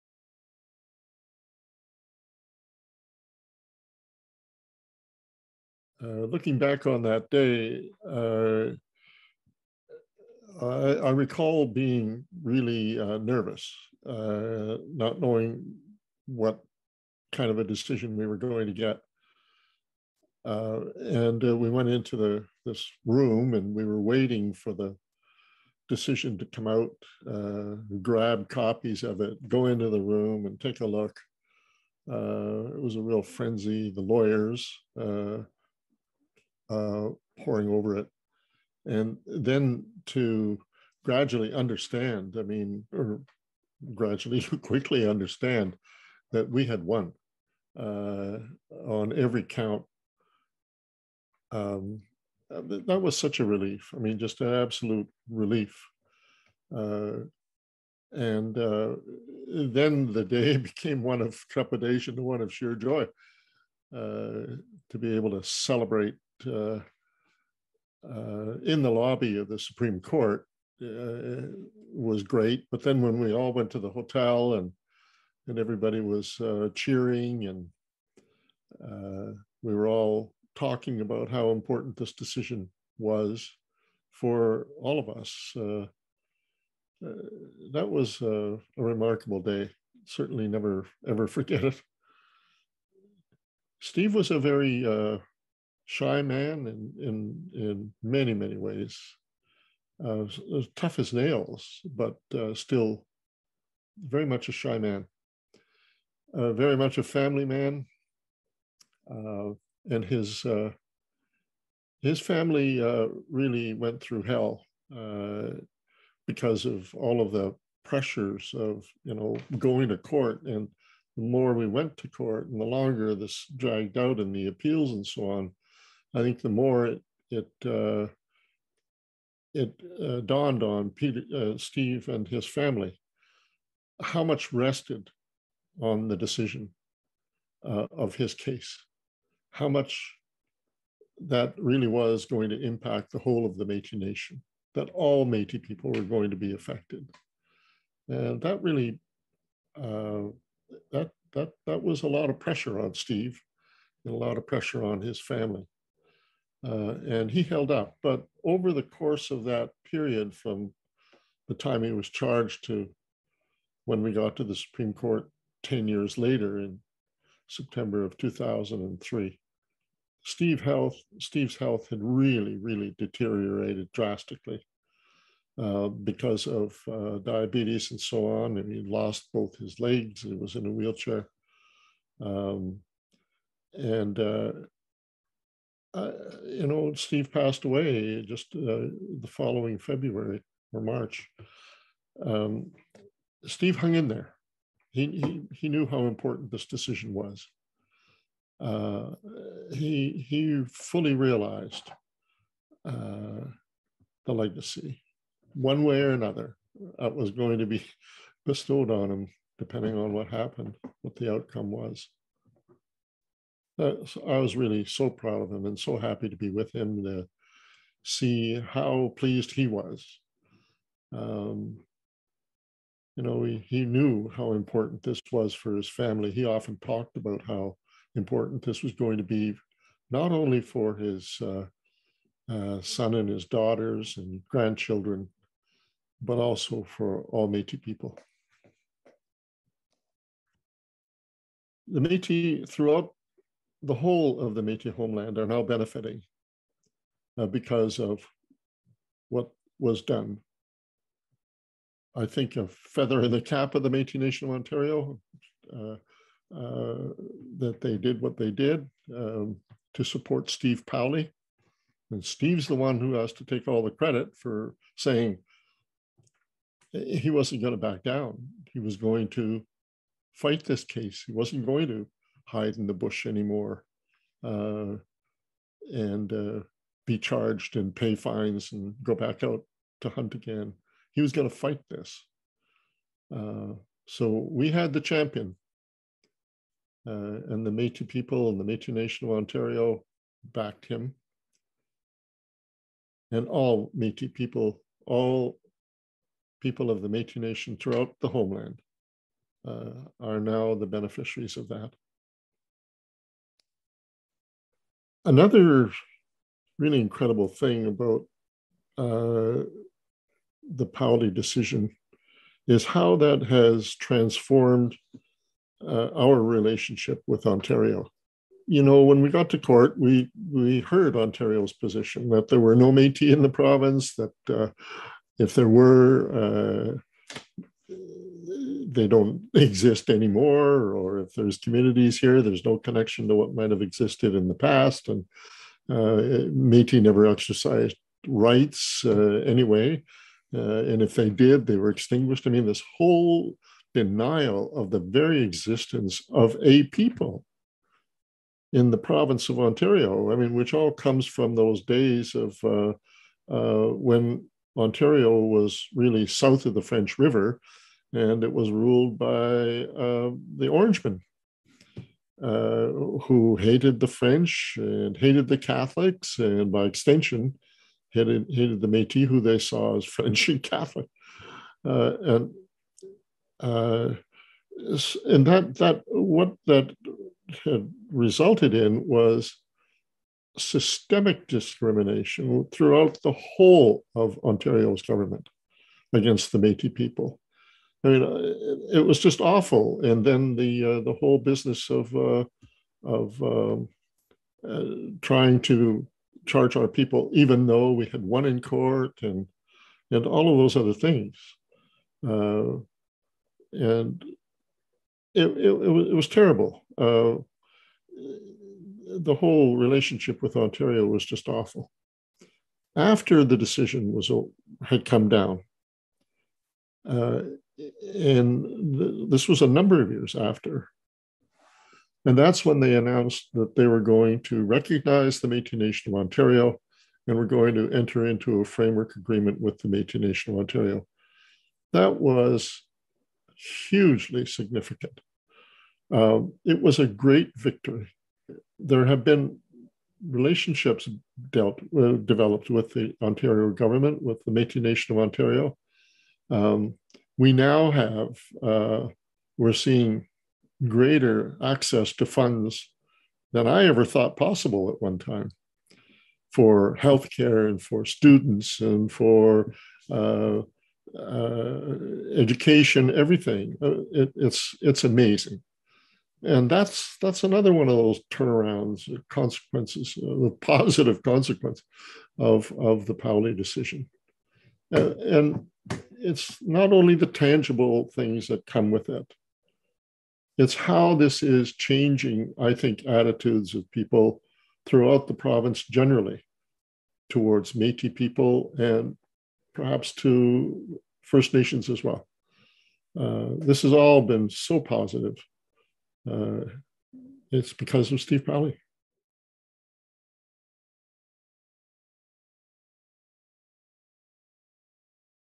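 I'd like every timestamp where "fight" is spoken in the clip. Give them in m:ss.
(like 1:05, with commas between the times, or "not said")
4:30, 4:41.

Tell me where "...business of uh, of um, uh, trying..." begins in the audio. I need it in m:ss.
6:31.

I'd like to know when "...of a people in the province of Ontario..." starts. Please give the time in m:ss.
5:46.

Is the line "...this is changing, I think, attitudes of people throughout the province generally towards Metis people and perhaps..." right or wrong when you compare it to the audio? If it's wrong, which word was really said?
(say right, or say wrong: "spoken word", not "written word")
right.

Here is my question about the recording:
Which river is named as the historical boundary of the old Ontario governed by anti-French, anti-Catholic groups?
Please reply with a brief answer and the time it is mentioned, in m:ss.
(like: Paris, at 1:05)
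French River, at 5:56.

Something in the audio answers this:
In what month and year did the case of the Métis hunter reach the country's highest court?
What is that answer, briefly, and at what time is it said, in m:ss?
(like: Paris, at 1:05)
September 2003, at 2:47.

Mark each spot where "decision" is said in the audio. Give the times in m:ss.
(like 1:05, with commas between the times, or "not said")
0:17, 0:25, 1:22, 2:16, 3:16, 5:11, 6:53, 7:53.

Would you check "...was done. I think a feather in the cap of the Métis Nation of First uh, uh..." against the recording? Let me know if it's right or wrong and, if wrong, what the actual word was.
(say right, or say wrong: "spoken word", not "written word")
wrong: "Ontario", not "First".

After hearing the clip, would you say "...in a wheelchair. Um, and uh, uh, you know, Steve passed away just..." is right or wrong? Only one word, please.
right.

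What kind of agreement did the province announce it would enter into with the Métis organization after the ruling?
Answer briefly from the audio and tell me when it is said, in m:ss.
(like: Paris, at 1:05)
Framework agreement, at 7:08.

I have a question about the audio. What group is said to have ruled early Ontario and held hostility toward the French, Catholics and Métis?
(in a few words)
The Orangemen.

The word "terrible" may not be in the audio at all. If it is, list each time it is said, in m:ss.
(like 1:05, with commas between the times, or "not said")
6:46.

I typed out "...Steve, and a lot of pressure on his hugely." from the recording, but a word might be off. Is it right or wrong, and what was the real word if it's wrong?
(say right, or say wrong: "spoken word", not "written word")
wrong: "family", not "hugely".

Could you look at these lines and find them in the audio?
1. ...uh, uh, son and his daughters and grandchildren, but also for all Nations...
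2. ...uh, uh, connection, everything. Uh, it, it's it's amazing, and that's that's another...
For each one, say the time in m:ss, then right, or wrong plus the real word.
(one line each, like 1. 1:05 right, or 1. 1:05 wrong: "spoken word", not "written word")
1. 3:51 wrong: "Métis", not "Nations"
2. 7:40 wrong: "education", not "connection".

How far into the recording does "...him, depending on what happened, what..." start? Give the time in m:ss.
3:29.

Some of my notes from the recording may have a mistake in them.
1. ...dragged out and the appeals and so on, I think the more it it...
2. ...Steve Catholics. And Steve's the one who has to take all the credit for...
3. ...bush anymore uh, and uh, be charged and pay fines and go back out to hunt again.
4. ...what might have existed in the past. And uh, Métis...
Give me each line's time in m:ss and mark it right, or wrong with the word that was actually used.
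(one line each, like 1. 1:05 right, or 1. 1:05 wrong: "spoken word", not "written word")
1. 2:03 right
2. 4:20 wrong: "Powley", not "Catholics"
3. 4:32 right
4. 5:33 right.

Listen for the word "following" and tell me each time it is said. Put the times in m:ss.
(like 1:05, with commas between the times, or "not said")
3:09.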